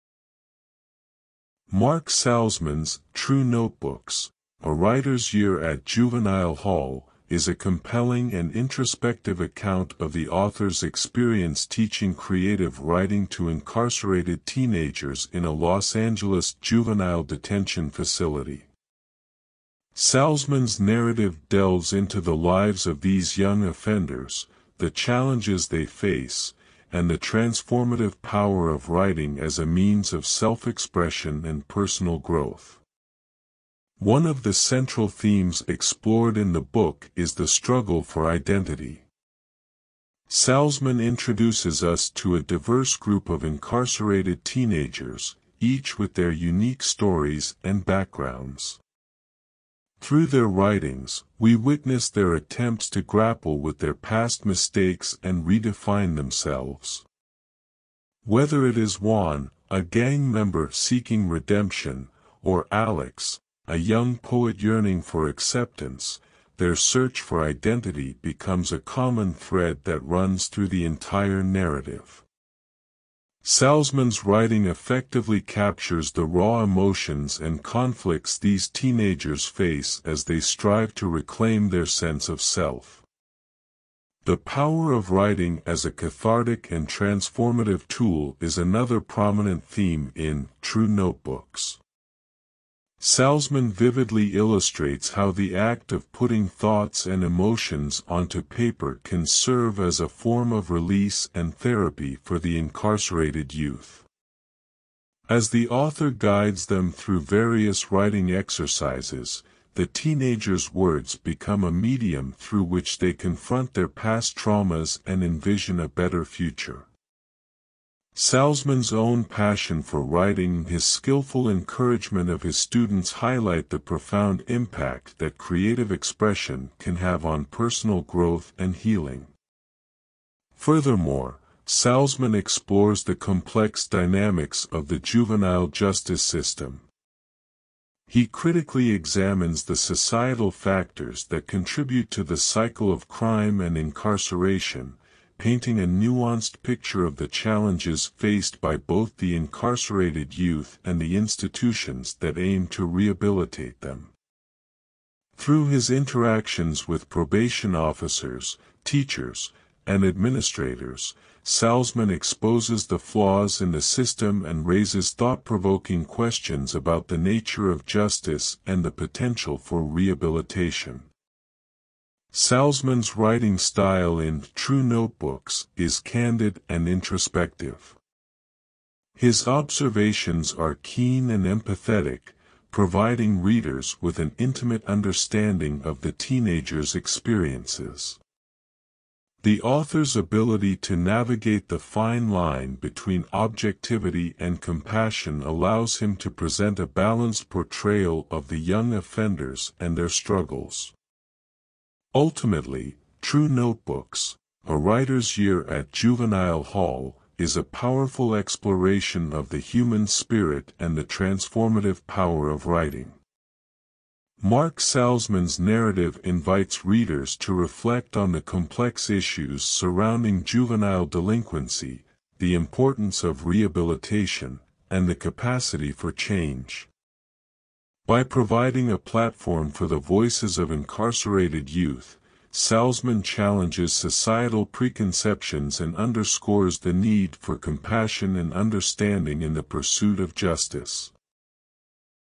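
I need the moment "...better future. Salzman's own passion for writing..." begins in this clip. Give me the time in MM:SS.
01:55.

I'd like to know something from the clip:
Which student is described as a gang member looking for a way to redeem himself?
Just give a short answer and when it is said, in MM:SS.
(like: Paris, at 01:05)
Juan, at 00:58.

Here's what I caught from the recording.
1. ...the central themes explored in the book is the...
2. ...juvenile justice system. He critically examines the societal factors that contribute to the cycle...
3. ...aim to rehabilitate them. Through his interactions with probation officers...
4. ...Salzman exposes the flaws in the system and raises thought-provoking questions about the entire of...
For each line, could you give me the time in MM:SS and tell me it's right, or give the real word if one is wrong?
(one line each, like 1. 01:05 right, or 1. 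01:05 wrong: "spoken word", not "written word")
1. 00:34 right
2. 02:14 right
3. 02:32 right
4. 02:41 wrong: "nature", not "entire".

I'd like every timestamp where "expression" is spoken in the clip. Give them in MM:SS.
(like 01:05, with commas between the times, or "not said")
00:30, 02:05.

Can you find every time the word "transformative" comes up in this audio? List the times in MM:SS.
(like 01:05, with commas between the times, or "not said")
00:27, 01:26, 03:31.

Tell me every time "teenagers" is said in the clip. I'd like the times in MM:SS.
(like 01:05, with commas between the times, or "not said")
00:14, 00:44, 01:18, 01:49, 03:06.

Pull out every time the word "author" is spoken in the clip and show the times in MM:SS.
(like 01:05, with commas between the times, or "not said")
00:10, 01:45, 03:09.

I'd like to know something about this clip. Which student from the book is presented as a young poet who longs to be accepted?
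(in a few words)
Alex.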